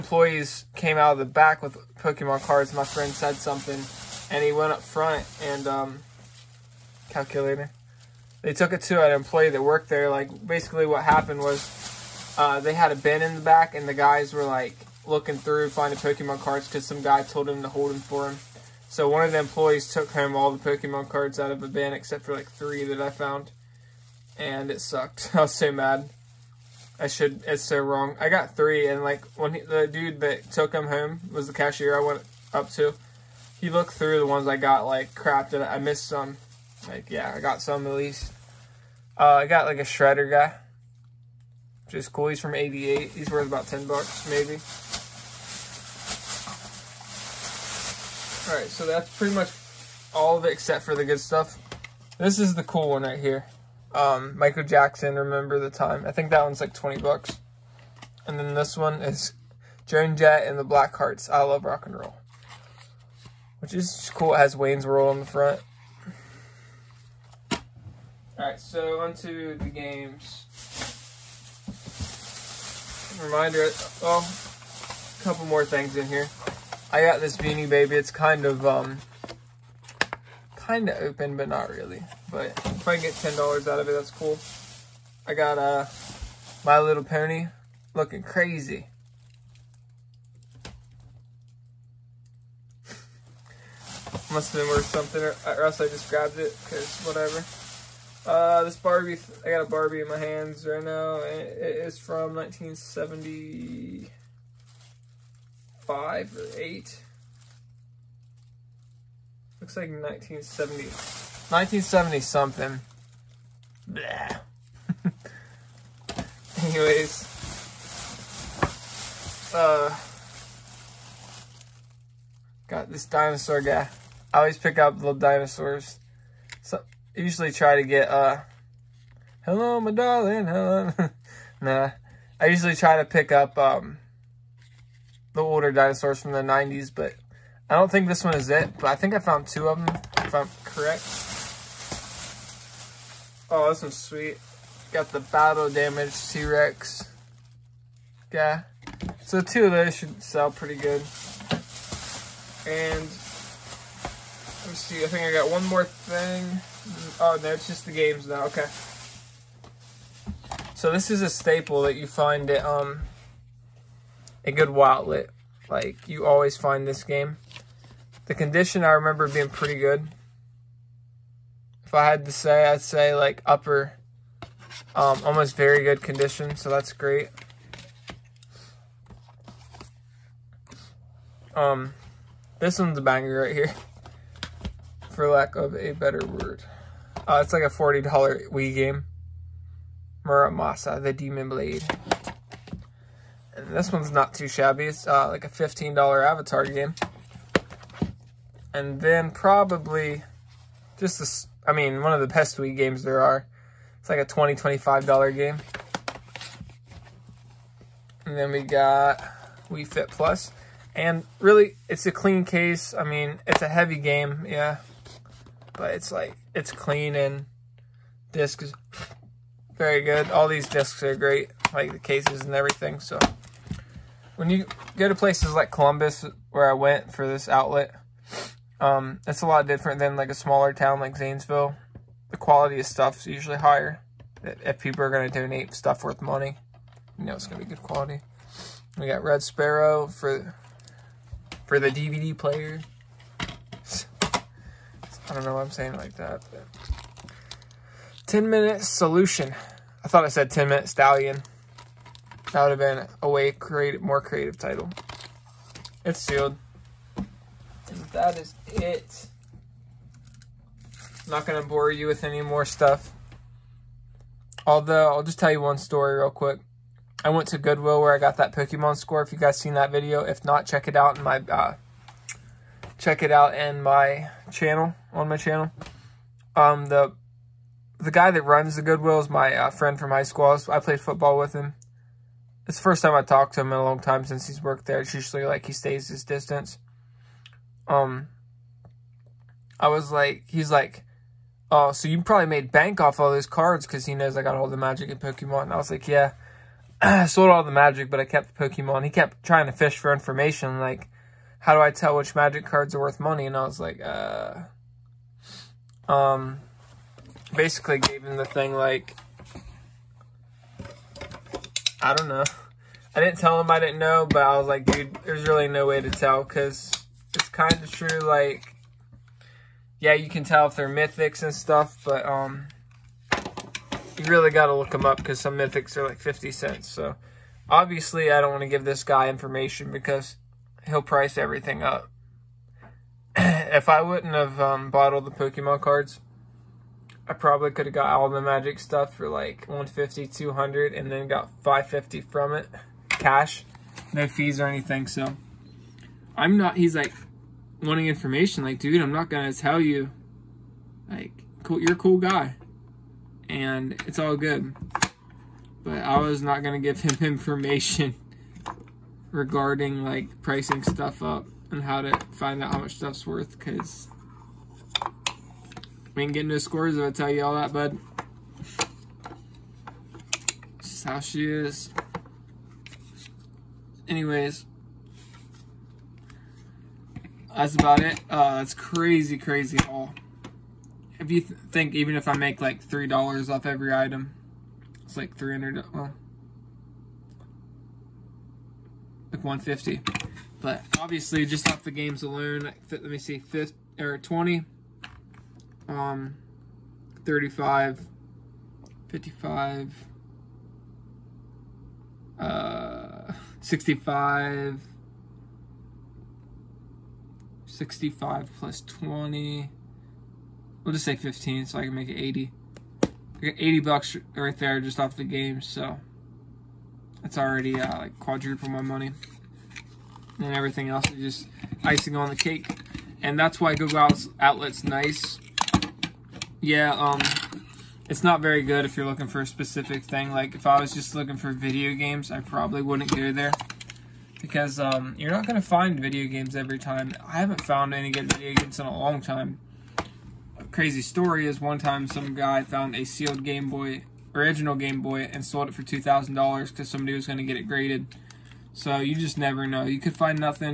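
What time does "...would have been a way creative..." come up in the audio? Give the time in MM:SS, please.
04:12.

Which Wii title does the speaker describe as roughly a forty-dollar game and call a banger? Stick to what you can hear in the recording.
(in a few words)
Muramasa, the Demon Blade.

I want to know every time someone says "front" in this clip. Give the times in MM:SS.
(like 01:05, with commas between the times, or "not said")
00:04, 01:05.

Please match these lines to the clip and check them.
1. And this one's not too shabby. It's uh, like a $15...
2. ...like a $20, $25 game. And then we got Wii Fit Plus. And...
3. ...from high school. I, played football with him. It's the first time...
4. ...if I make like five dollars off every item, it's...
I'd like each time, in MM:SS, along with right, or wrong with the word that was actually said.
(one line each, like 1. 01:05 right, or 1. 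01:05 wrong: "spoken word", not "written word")
1. 03:13 right
2. 03:24 right
3. 04:39 right
4. 06:22 wrong: "three", not "five".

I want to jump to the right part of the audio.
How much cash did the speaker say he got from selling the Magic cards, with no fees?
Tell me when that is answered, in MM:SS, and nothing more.
05:41.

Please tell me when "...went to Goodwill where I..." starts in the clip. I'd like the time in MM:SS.
04:27.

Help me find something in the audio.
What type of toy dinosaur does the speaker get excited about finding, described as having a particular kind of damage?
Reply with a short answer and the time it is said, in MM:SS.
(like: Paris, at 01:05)
Battle damage T-Rex, at 02:25.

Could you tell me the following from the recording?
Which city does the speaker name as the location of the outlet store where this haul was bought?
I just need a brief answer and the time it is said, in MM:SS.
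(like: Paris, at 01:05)
Columbus, at 03:45.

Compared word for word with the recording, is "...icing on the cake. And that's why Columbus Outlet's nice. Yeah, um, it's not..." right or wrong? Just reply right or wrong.
wrong.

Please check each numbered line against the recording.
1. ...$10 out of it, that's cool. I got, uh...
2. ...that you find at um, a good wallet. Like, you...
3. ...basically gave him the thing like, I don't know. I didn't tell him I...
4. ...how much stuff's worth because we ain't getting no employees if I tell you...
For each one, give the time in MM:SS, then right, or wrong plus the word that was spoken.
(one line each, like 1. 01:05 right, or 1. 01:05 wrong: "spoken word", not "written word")
1. 01:23 right
2. 02:41 right
3. 05:07 right
4. 06:02 wrong: "scores", not "employees".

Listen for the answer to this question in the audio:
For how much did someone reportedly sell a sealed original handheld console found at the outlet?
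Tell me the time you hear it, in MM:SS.
07:25.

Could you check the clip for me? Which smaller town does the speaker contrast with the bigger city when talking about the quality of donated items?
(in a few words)
Zanesville.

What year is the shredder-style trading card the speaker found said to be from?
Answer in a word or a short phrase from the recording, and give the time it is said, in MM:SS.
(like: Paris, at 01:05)
1988, at 00:42.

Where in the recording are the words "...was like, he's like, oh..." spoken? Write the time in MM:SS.
04:49.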